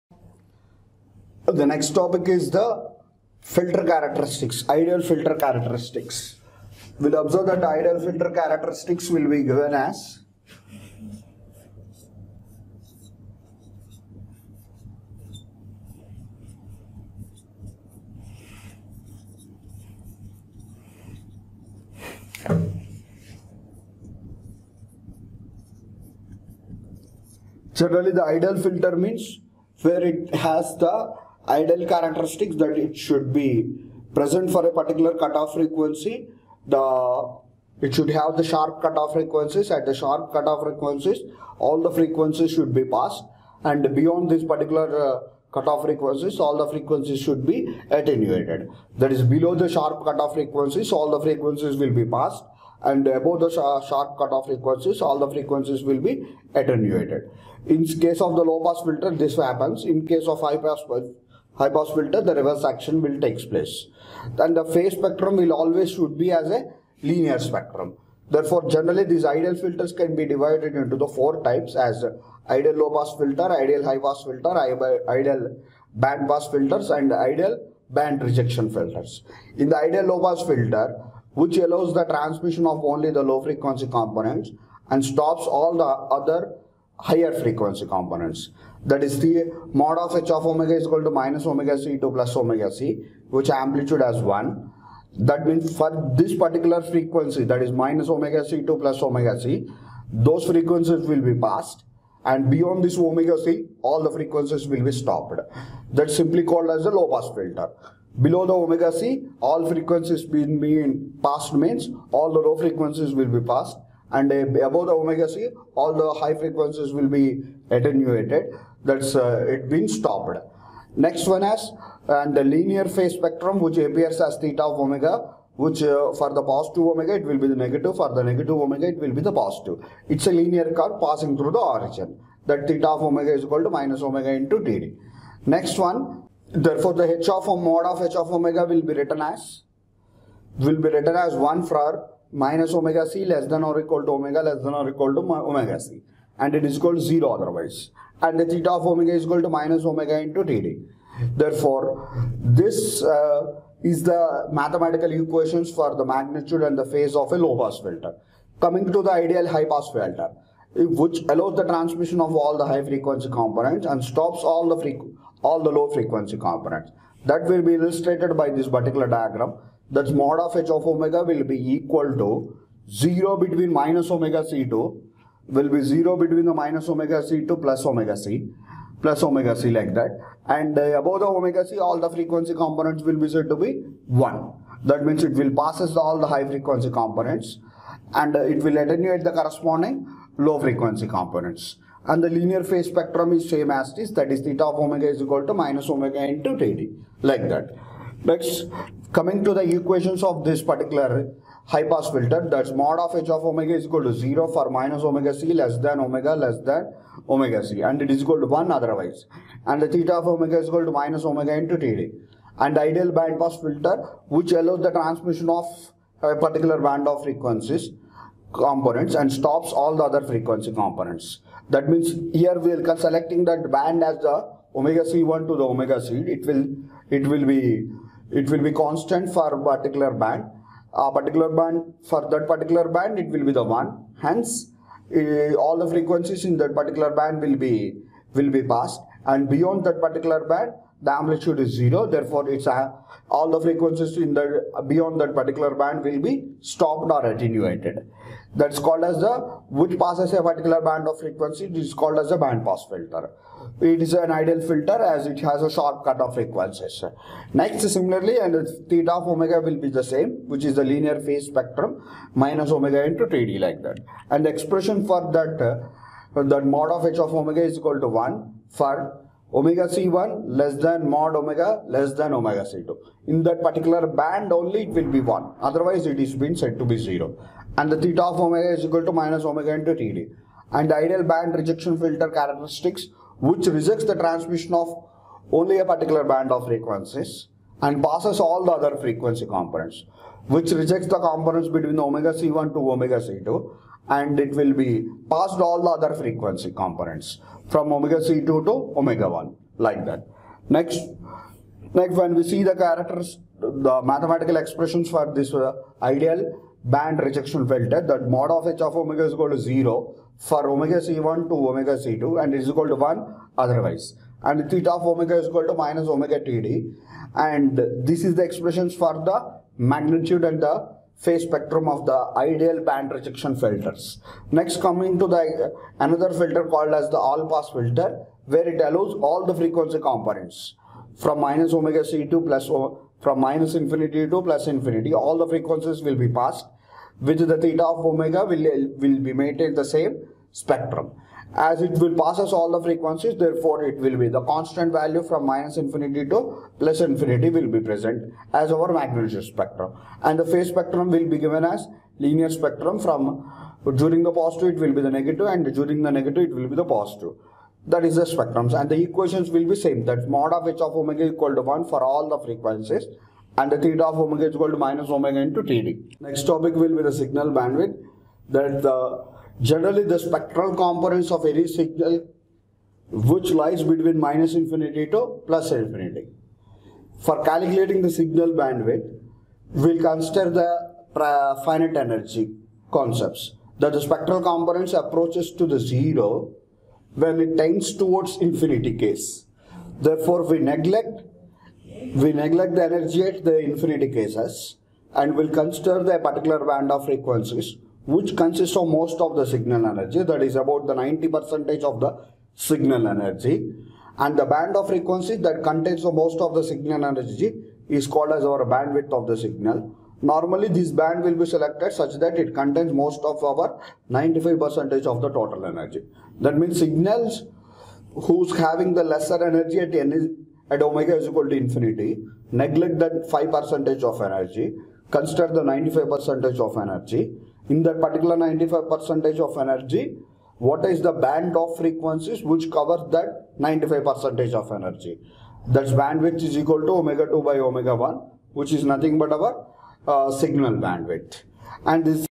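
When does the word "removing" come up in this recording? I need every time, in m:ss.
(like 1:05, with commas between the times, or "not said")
not said.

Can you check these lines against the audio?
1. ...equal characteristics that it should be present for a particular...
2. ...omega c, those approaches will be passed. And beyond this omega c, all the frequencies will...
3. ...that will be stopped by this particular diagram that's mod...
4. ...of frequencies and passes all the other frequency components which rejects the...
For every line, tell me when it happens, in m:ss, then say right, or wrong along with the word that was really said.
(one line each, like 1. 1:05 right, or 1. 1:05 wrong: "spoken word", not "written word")
1. 0:31 wrong: "ideal", not "equal"
2. 1:39 wrong: "frequencies", not "approaches"
3. 2:47 wrong: "illustrated", not "stopped"
4. 4:46 right.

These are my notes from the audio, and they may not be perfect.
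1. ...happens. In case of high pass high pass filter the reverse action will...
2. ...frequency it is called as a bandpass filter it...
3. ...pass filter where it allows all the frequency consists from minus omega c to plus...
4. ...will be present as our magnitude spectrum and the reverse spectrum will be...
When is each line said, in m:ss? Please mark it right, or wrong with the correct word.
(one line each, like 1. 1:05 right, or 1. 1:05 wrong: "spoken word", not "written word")
1. 0:59 right
2. 4:11 right
3. 5:27 wrong: "components", not "consists"
4. 5:47 wrong: "phase", not "reverse".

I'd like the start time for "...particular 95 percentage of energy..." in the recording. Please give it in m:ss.
7:08.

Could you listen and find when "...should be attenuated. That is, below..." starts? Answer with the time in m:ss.
0:47.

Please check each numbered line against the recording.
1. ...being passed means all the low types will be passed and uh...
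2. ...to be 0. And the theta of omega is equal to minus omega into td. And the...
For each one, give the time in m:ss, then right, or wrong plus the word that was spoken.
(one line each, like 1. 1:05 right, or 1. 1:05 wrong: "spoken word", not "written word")
1. 1:50 wrong: "frequencies", not "types"
2. 4:36 right.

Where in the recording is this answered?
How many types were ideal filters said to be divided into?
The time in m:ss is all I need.
1:11.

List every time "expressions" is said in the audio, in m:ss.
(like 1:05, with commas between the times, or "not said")
4:24, 5:04, 5:18.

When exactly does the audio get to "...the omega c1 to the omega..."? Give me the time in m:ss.
3:44.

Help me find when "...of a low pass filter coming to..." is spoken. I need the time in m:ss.
2:37.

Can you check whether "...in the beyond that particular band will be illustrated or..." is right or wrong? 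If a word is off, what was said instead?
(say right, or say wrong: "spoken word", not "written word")
wrong: "stopped", not "illustrated".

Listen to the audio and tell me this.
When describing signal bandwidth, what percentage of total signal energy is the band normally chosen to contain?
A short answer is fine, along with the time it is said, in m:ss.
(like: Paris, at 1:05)
95 percent, at 6:54.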